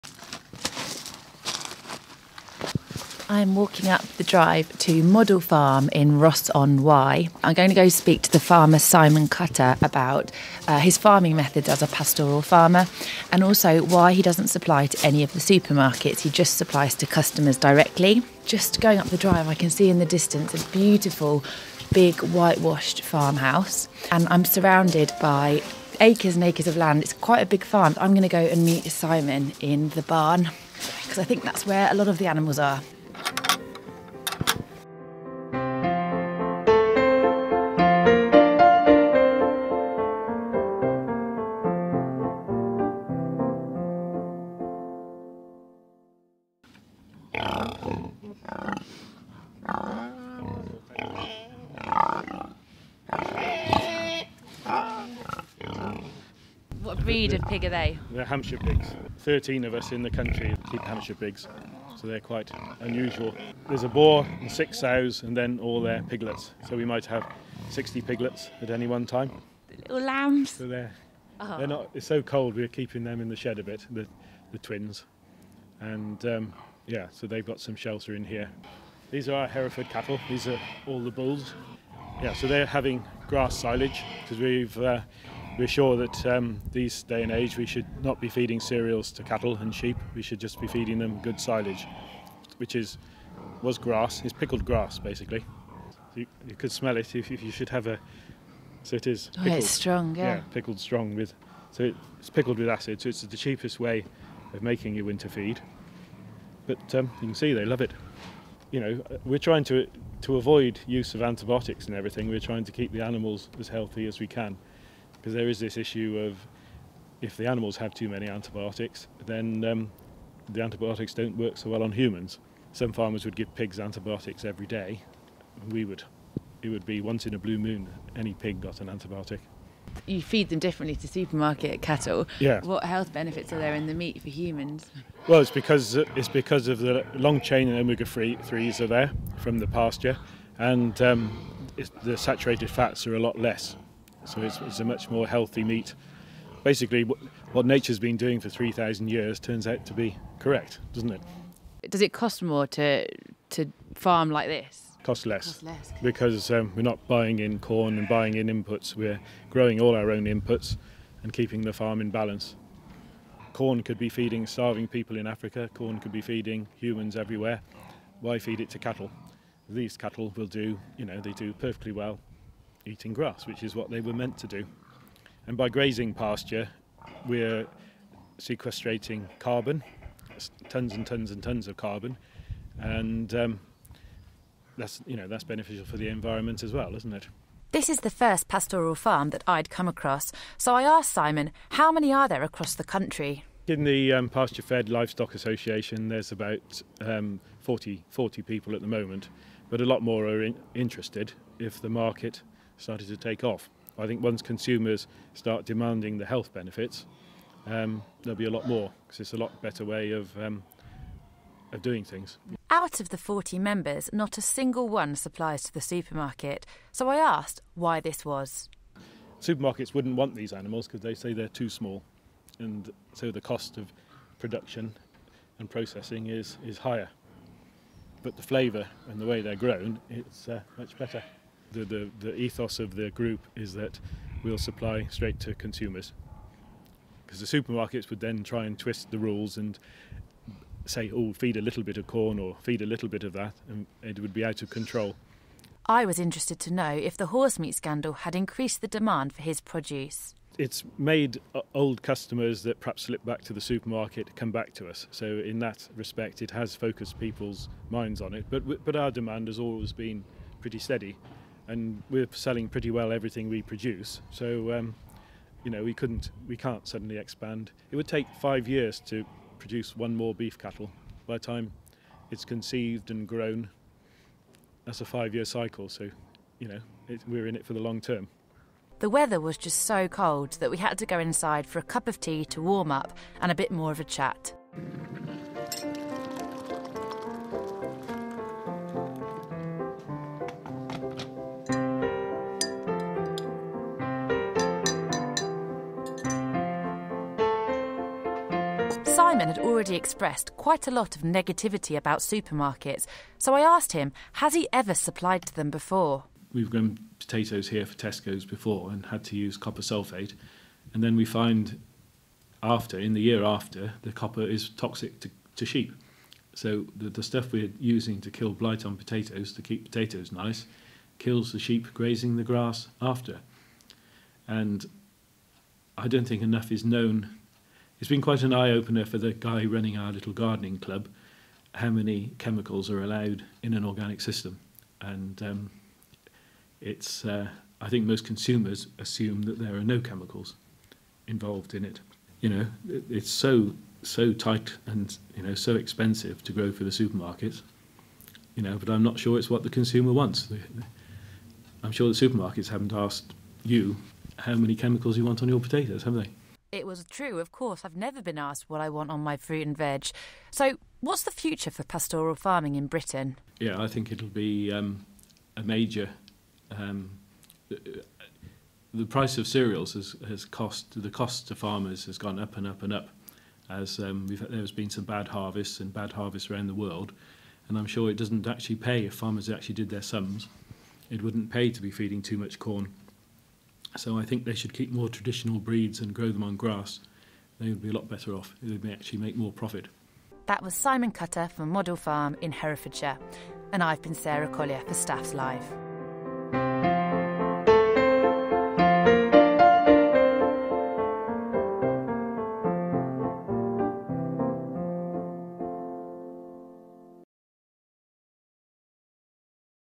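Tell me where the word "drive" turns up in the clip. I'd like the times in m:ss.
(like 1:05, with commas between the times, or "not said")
0:04, 0:19.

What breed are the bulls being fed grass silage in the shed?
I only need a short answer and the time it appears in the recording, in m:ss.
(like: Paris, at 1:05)
Hereford, at 1:19.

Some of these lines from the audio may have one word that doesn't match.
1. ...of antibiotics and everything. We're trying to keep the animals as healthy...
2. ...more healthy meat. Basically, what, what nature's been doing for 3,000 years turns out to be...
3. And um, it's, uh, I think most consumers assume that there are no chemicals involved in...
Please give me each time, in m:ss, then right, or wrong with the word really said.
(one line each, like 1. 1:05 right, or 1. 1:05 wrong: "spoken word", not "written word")
1. 1:51 right
2. 2:25 right
3. 5:34 right.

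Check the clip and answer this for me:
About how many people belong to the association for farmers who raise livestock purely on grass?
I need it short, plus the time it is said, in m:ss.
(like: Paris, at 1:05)
40, at 3:18.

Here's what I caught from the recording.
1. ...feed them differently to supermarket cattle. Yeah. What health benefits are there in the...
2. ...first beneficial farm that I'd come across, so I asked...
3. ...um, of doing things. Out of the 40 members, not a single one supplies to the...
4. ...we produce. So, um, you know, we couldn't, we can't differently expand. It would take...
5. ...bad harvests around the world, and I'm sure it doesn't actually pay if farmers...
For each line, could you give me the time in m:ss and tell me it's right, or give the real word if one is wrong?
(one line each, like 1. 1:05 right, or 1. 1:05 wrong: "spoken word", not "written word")
1. 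2:10 right
2. 3:08 wrong: "pastoral", not "beneficial"
3. 3:30 right
4. 4:23 wrong: "suddenly", not "differently"
5. 6:15 right.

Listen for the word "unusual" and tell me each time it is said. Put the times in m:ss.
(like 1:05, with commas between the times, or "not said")
1:02.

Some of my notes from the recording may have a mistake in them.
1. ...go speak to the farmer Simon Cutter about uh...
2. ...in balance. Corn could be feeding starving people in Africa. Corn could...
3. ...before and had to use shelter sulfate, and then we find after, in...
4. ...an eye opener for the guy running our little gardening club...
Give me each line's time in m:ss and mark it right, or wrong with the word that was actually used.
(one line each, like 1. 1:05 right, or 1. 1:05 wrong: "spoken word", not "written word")
1. 0:07 right
2. 2:42 right
3. 5:08 wrong: "copper", not "shelter"
4. 5:28 right.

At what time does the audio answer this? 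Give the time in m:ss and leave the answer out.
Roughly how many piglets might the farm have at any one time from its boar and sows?
1:07.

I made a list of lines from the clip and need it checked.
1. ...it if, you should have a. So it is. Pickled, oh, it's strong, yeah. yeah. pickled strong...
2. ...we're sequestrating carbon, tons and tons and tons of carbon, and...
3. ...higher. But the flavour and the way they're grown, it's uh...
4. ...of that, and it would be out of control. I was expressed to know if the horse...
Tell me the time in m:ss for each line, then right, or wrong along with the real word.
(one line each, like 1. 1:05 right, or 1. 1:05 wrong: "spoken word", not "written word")
1. 1:36 right
2. 2:57 right
3. 3:46 right
4. 4:03 wrong: "interested", not "expressed".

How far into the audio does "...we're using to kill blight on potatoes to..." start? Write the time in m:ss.
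5:17.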